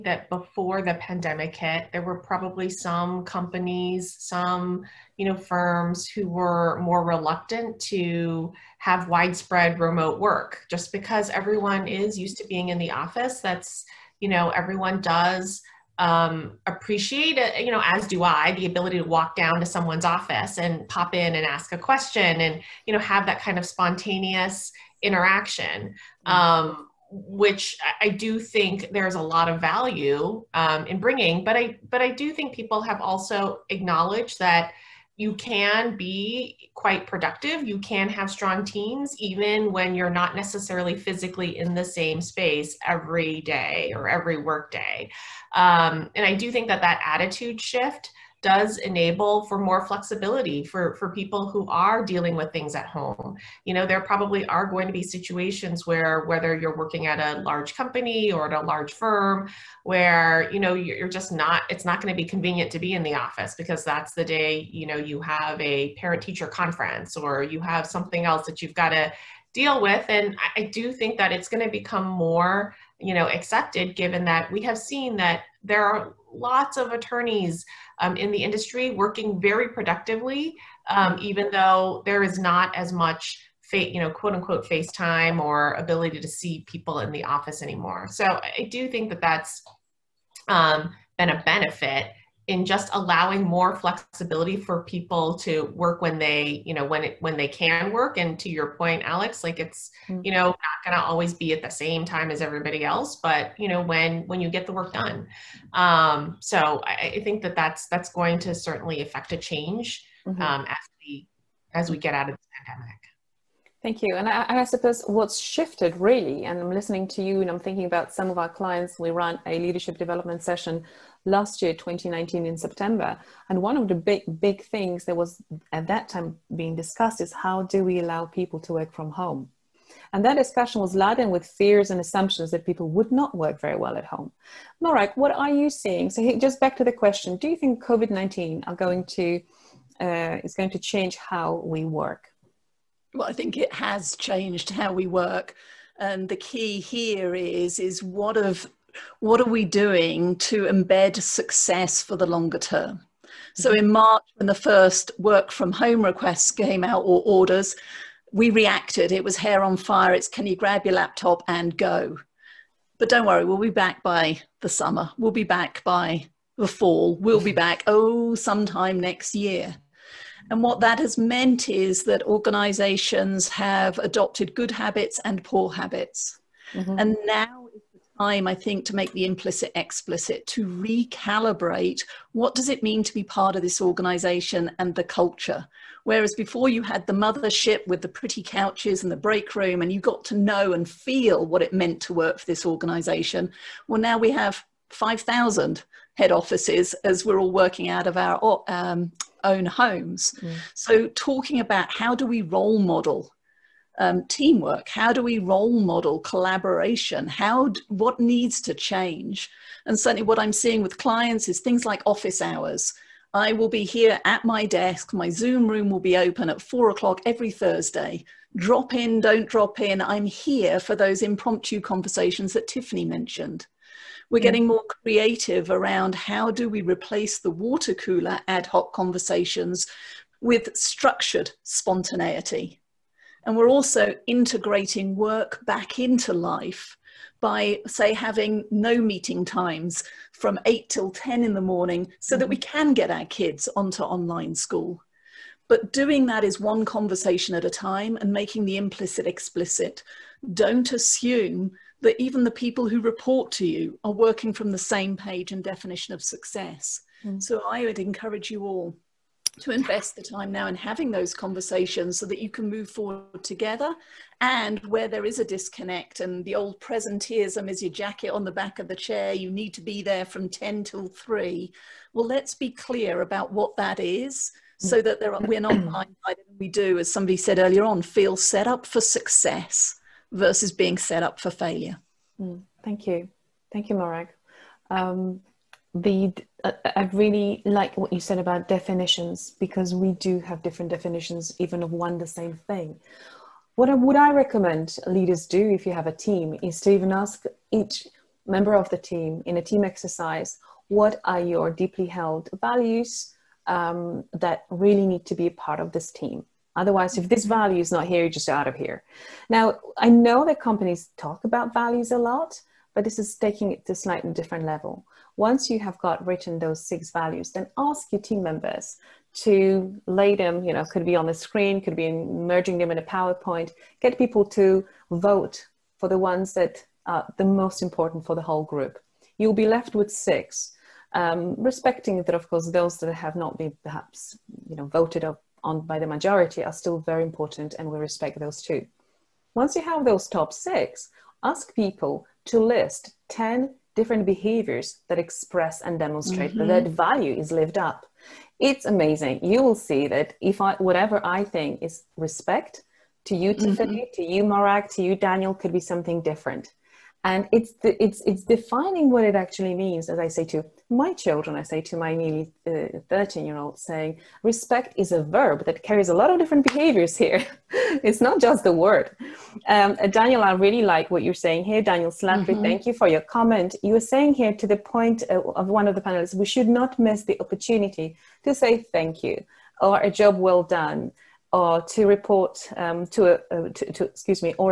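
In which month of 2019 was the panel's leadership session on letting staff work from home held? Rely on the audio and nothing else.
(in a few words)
September.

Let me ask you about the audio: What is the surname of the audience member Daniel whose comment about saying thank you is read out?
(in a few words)
Slattery.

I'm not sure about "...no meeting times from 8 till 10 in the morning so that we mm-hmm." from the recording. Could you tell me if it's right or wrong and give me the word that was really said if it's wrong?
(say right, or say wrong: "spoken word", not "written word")
right.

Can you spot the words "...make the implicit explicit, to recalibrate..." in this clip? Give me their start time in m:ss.
2:58.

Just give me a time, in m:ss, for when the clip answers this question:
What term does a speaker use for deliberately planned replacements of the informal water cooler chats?
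3:50.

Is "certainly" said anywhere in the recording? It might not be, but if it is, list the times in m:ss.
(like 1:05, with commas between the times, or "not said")
1:48, 3:29.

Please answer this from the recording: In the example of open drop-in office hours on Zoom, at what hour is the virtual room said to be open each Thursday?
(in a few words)
4 o'clock.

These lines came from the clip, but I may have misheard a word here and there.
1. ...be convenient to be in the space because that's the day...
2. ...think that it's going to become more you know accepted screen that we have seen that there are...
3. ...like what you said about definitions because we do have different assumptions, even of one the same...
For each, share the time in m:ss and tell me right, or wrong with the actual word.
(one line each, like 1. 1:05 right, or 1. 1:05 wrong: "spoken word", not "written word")
1. 1:02 wrong: "office", not "space"
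2. 1:10 wrong: "given", not "screen"
3. 4:47 wrong: "definitions", not "assumptions".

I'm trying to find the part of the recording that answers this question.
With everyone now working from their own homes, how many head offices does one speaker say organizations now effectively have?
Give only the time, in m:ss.
3:14.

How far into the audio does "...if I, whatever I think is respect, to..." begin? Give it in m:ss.
5:50.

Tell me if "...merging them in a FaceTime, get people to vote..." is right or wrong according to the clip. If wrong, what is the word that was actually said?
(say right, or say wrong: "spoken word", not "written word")
wrong: "PowerPoint", not "FaceTime".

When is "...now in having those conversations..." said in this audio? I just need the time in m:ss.
4:20.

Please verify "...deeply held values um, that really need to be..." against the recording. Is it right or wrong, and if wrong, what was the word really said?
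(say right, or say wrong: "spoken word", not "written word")
right.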